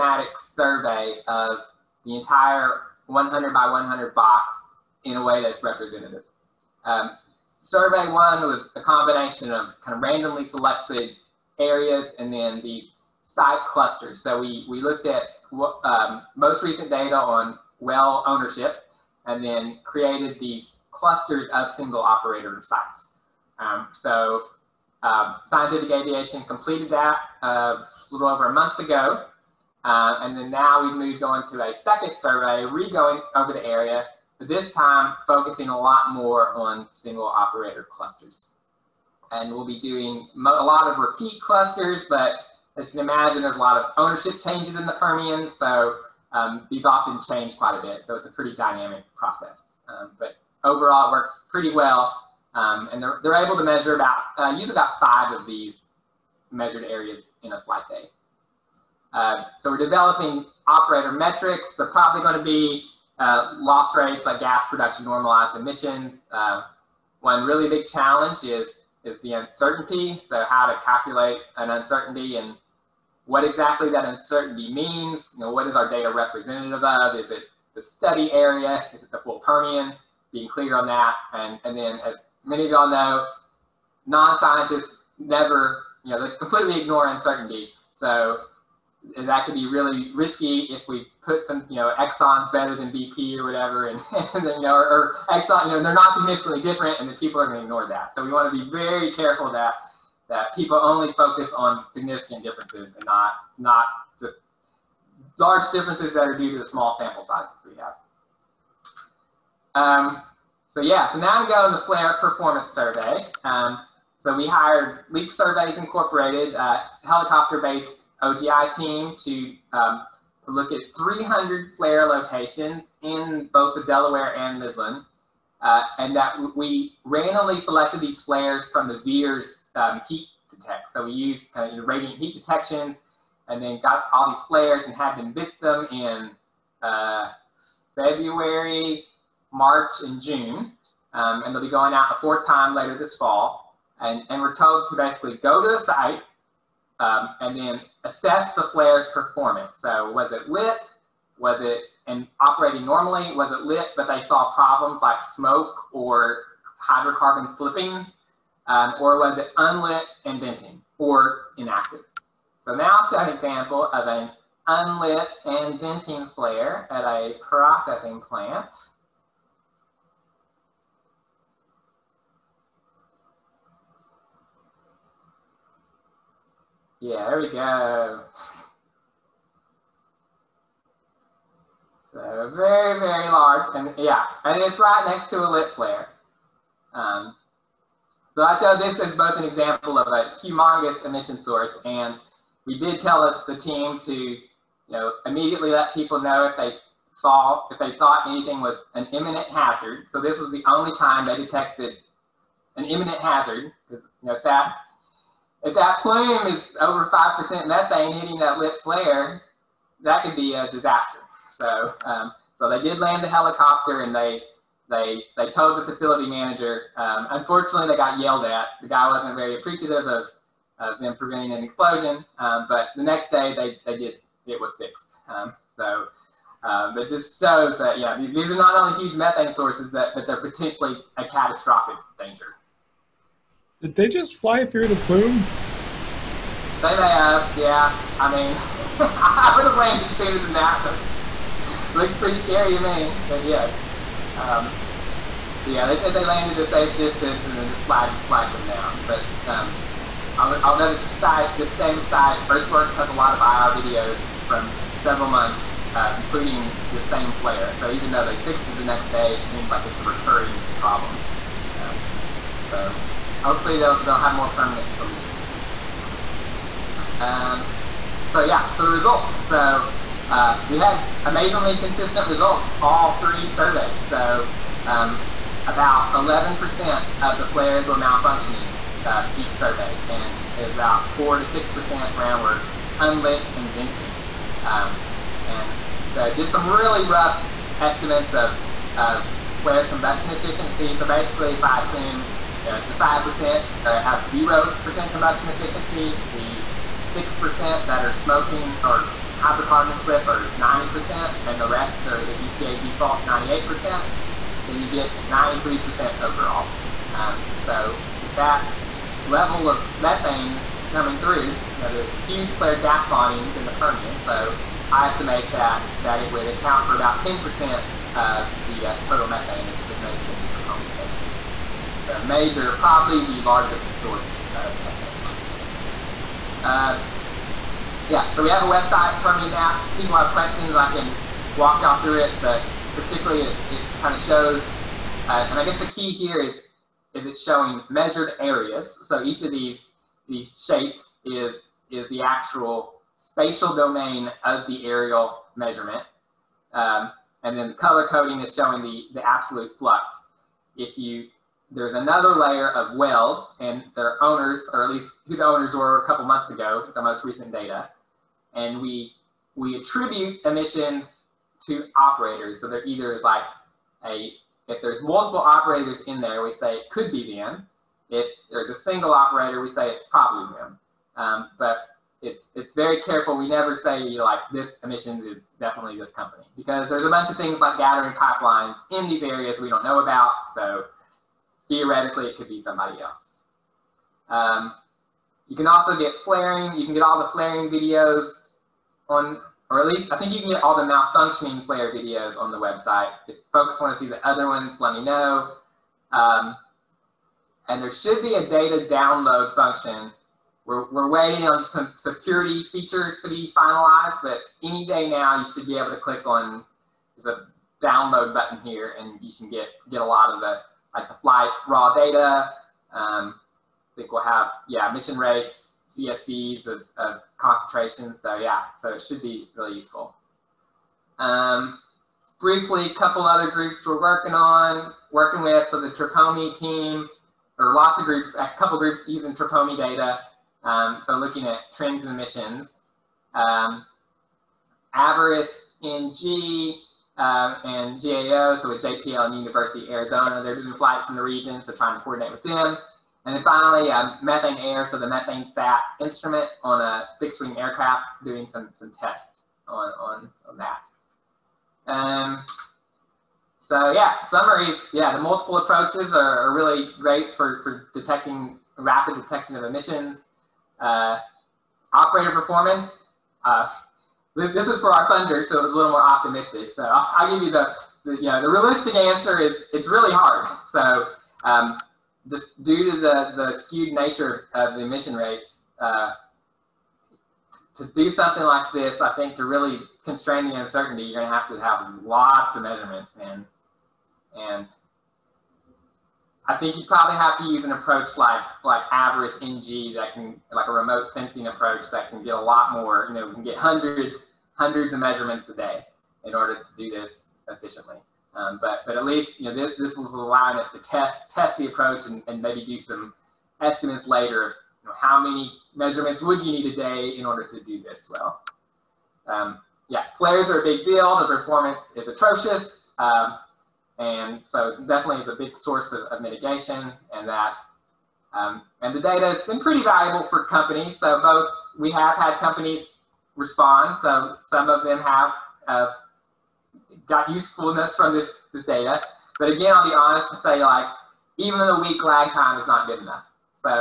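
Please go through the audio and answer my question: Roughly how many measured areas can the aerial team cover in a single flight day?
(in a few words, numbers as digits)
5.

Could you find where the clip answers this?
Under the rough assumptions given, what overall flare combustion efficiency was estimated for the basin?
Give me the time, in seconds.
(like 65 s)
305 s.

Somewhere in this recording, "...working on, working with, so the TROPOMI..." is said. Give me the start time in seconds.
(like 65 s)
423 s.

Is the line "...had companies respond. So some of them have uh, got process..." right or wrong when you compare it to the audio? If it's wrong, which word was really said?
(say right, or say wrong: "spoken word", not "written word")
wrong: "usefulness", not "process".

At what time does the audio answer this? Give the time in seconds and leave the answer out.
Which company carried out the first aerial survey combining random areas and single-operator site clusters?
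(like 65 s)
25 s.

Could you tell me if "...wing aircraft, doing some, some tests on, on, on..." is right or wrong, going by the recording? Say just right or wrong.
right.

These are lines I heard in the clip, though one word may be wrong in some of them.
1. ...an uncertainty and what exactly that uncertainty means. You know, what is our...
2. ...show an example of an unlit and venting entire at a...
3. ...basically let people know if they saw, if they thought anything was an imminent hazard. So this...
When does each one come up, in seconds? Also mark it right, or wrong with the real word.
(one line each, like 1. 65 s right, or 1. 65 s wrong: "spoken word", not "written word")
1. 71 s right
2. 163 s wrong: "flare", not "entire"
3. 195 s wrong: "immediately", not "basically".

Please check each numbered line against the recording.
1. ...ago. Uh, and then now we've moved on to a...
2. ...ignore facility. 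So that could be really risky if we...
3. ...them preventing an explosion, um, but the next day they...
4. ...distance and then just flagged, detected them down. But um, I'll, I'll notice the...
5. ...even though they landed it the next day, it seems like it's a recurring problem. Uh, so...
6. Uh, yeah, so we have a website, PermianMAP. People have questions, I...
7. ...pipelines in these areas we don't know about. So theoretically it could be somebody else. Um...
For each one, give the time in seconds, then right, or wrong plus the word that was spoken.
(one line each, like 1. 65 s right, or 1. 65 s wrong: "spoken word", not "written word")
1. 28 s right
2. 86 s wrong: "uncertainty", not "facility"
3. 220 s right
4. 246 s wrong: "flagged", not "detected"
5. 257 s wrong: "fixed", not "landed"
6. 326 s right
7. 378 s right.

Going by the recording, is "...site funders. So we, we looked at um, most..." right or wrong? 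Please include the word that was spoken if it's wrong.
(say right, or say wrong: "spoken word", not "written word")
wrong: "clusters", not "funders".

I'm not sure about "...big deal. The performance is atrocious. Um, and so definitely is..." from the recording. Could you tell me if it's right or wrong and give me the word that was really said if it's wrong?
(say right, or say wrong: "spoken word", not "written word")
right.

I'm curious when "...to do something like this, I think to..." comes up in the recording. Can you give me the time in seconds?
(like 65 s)
477 s.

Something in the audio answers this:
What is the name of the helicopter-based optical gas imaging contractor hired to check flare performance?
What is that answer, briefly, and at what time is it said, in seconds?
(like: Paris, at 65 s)
Leak Surveys Incorporated, at 115 s.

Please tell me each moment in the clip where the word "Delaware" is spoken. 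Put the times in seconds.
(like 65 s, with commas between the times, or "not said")
123 s.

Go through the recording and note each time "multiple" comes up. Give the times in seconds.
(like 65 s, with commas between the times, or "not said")
365 s, 455 s.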